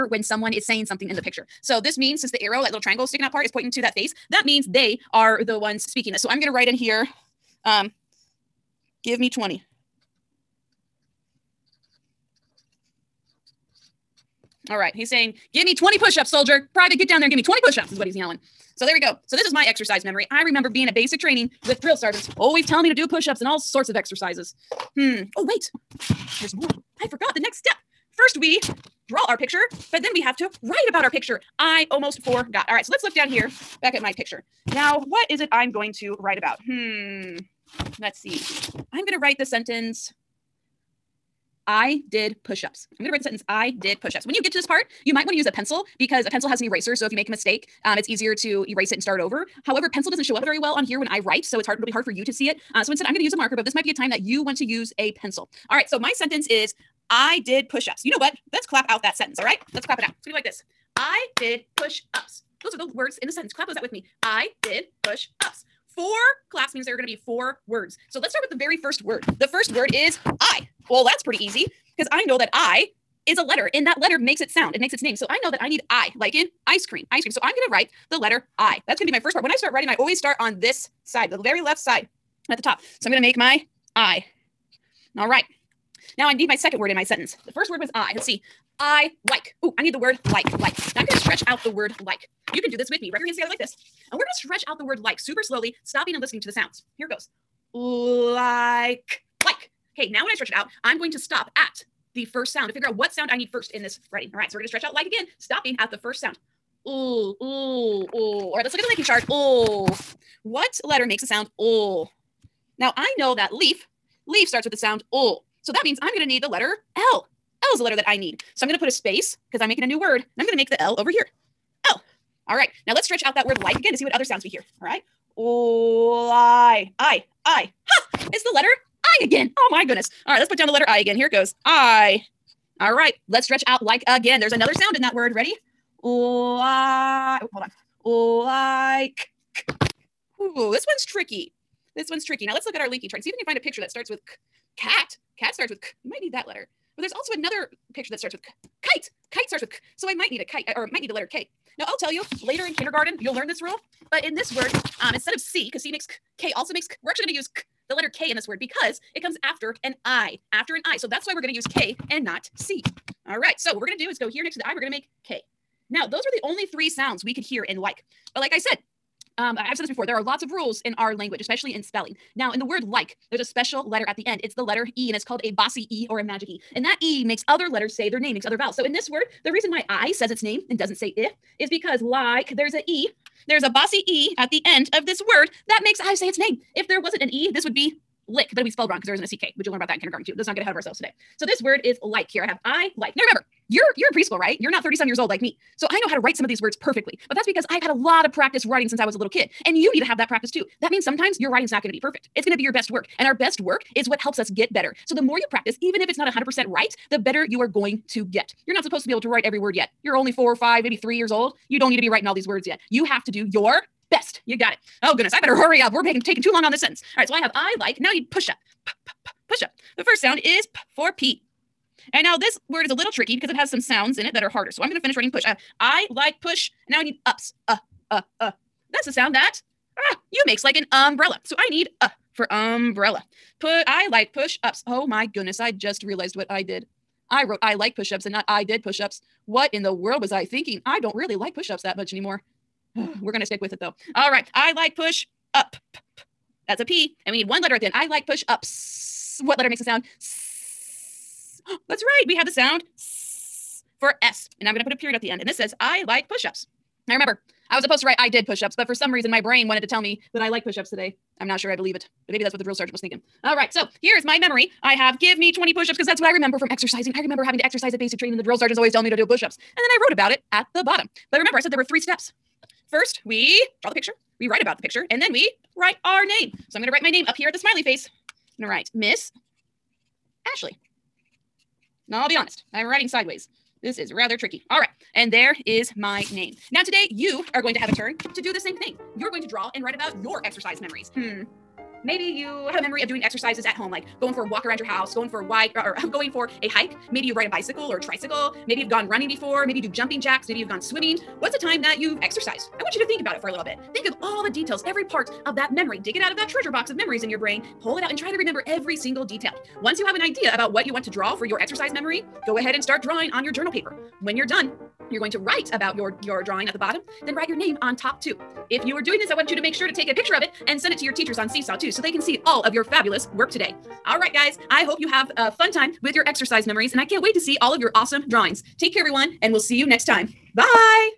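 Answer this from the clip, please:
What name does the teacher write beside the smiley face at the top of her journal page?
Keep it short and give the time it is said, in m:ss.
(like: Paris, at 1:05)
Miss Ashley, at 4:38.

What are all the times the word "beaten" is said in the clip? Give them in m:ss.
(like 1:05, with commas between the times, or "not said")
not said.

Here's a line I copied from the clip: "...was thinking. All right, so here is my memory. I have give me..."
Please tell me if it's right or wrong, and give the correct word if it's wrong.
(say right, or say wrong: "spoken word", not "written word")
right.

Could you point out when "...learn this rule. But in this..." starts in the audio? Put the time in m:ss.
2:33.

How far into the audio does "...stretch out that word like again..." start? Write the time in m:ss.
2:03.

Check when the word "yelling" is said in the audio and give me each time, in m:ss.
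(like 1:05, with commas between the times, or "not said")
0:18.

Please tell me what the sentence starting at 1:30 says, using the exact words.
Now I'm going to stretch out the word like.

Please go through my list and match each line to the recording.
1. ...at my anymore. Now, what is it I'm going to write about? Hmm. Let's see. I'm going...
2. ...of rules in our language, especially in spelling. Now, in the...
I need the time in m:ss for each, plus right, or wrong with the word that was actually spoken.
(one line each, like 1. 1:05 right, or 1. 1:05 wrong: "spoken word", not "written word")
1. 0:33 wrong: "picture", not "anymore"
2. 2:50 right.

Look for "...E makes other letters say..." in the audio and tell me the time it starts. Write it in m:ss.
2:57.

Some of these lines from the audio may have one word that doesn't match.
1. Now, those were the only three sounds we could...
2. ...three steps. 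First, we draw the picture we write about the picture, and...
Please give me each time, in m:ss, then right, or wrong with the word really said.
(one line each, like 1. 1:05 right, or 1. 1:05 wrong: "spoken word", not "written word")
1. 2:45 right
2. 4:31 right.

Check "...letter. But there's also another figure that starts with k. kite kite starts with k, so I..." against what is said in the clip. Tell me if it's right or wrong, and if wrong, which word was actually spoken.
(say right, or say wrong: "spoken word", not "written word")
wrong: "picture", not "figure".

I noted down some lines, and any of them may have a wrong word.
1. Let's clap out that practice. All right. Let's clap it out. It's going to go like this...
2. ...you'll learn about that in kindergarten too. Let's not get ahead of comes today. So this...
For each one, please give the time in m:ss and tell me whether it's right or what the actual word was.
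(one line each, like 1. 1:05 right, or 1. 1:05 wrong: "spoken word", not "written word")
1. 0:58 wrong: "sentence", not "practice"
2. 3:09 wrong: "ourselves", not "comes".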